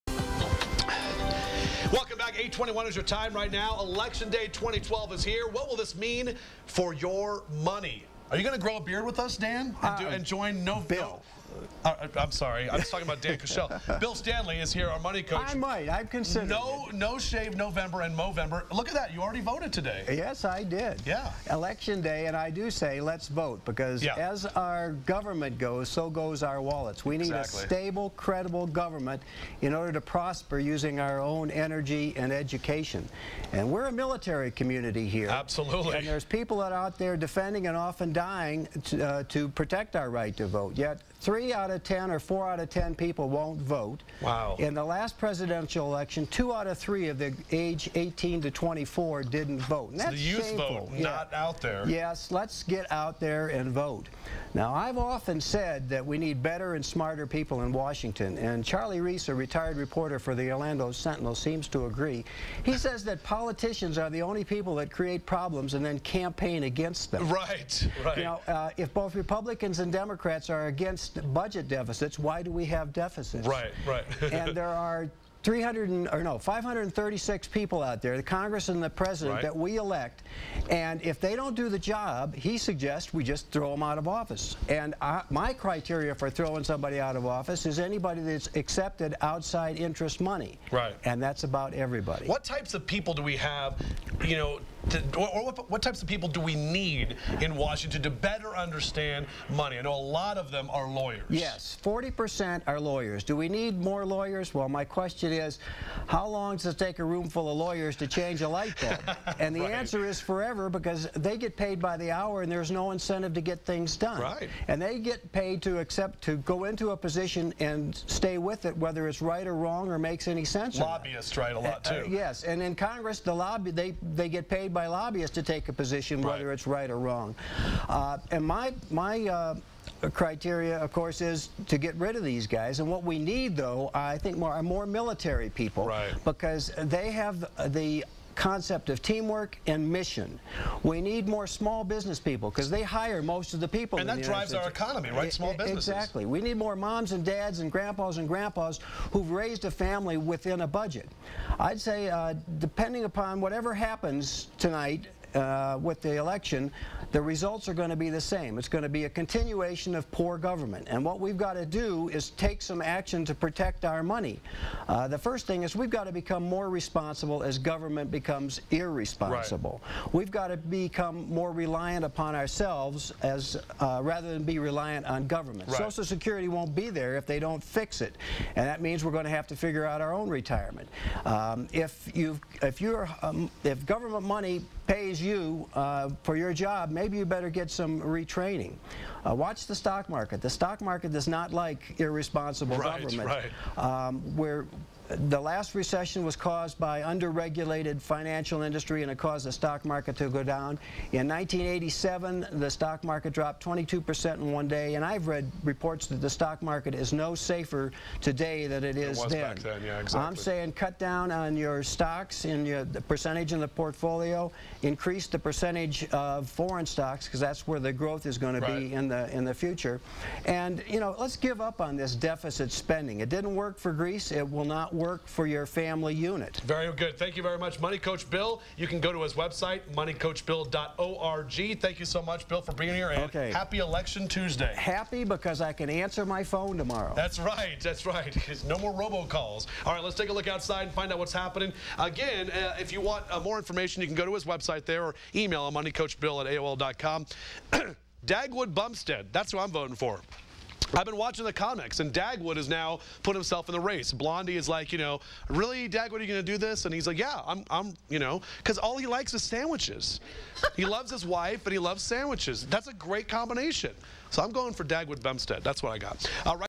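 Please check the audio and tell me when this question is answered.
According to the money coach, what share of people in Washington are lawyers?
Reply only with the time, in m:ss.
1:41.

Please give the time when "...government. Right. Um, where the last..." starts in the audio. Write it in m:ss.
3:13.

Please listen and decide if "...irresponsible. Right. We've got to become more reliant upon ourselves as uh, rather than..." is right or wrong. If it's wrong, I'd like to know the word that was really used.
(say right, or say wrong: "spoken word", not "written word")
right.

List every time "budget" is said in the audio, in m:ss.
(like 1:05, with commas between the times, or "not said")
1:11, 2:30.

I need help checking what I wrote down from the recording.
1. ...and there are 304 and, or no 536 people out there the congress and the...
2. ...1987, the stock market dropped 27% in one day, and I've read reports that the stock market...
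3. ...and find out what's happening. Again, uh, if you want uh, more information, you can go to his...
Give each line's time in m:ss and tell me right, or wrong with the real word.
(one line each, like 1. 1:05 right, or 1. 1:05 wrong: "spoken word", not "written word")
1. 1:14 wrong: "300", not "304"
2. 3:21 wrong: "22", not "27"
3. 4:00 right.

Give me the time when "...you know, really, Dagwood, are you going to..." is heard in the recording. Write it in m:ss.
4:14.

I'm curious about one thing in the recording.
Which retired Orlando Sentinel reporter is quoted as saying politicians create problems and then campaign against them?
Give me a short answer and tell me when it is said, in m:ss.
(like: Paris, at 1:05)
Charlie Reese, at 0:58.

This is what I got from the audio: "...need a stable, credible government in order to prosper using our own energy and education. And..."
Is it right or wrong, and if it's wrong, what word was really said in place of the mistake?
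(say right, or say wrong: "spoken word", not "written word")
right.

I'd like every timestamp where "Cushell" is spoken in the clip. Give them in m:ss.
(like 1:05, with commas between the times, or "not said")
0:13.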